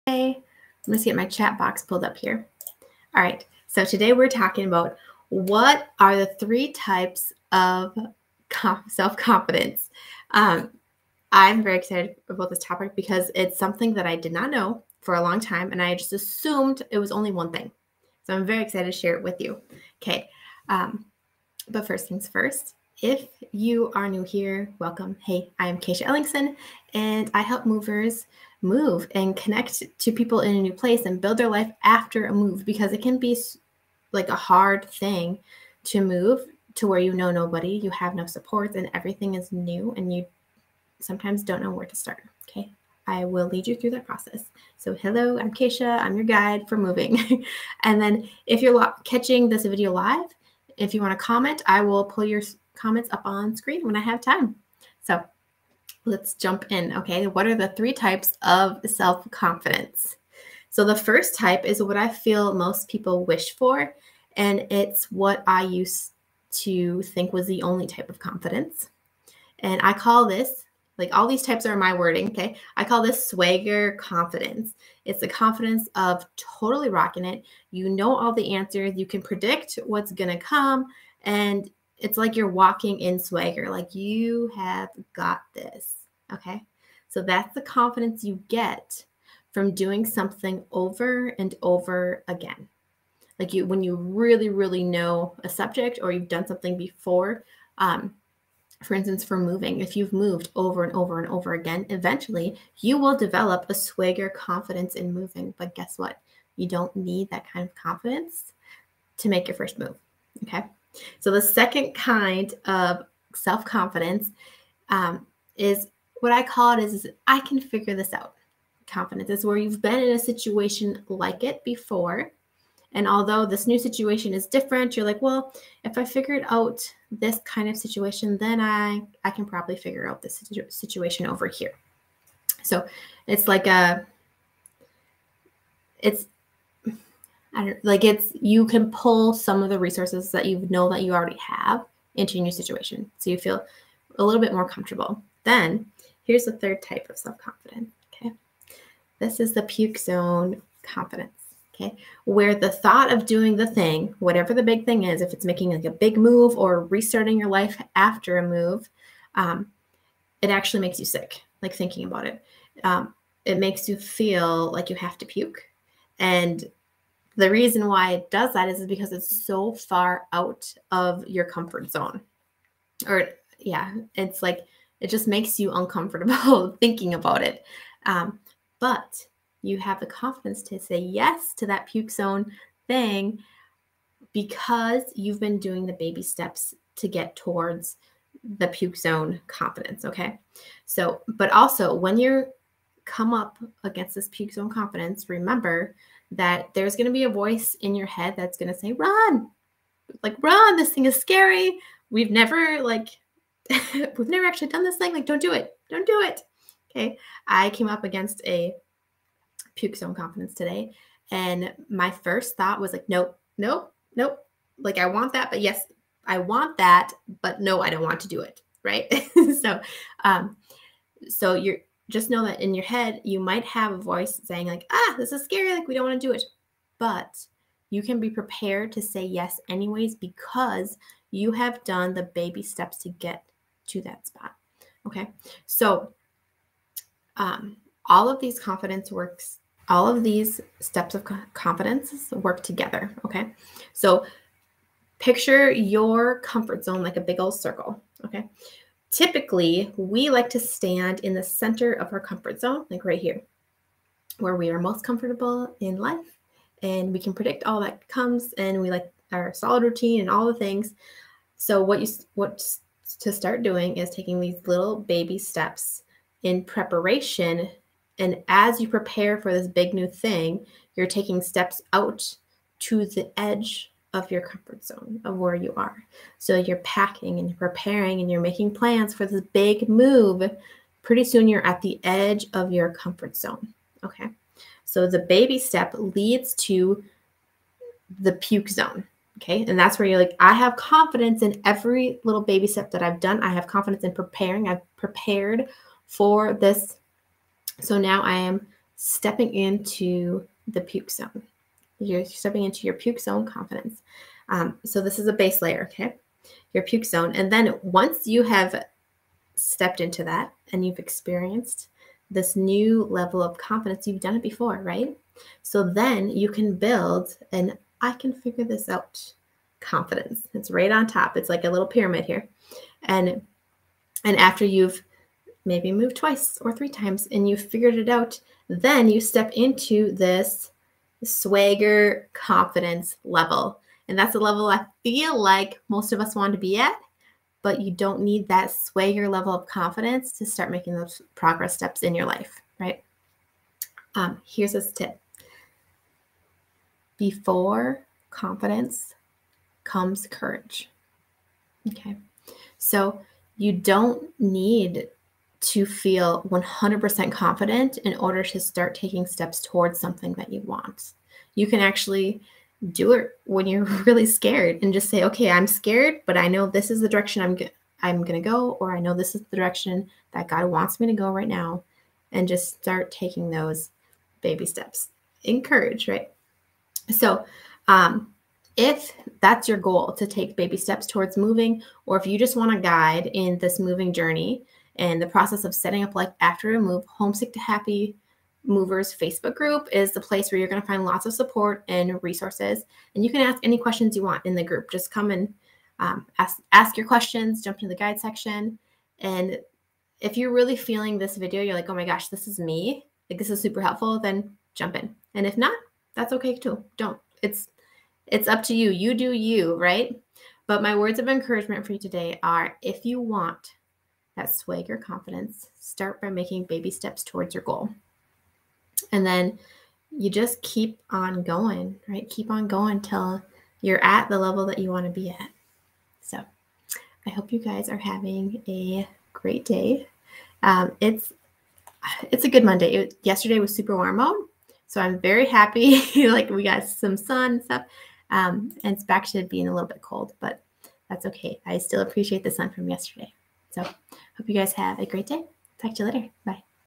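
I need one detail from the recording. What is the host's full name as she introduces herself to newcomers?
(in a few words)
Kaycia Ellingsen.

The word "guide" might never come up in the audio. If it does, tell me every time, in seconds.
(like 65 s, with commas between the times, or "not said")
46 s, 382 s, 397 s.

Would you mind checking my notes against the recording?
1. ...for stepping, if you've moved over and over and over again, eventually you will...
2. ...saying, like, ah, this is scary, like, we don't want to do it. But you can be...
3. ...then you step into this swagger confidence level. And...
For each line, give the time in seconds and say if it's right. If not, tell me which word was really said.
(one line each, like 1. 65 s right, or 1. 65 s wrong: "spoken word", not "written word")
1. 99 s wrong: "moving", not "stepping"
2. 224 s right
3. 328 s right.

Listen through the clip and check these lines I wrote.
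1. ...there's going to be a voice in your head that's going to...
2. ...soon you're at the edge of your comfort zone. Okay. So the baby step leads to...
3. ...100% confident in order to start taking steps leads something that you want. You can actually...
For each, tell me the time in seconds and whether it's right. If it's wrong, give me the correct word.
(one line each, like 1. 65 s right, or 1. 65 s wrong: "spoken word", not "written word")
1. 196 s right
2. 281 s right
3. 356 s wrong: "towards", not "leads".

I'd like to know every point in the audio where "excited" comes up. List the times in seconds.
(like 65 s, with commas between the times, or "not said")
11 s, 18 s.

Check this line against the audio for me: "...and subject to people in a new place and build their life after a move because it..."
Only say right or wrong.
wrong.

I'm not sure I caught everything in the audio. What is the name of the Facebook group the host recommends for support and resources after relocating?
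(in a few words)
Homesick to Happy Movers.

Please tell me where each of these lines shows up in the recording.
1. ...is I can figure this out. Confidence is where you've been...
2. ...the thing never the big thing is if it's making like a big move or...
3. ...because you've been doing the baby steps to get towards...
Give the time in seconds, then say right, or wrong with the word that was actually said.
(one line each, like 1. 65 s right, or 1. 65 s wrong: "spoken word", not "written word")
1. 117 s right
2. 153 s wrong: "whatever", not "never"
3. 184 s right.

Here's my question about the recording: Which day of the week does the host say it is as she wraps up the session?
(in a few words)
Monday.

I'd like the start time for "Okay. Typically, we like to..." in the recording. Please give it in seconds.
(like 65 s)
248 s.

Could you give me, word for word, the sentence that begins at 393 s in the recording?
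And you can ask any questions you want in the group.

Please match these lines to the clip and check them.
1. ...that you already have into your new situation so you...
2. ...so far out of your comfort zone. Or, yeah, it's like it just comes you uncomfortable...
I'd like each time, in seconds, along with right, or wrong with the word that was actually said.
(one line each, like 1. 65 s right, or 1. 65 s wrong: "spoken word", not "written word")
1. 140 s right
2. 169 s wrong: "makes", not "comes".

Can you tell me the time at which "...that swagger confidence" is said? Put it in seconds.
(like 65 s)
414 s.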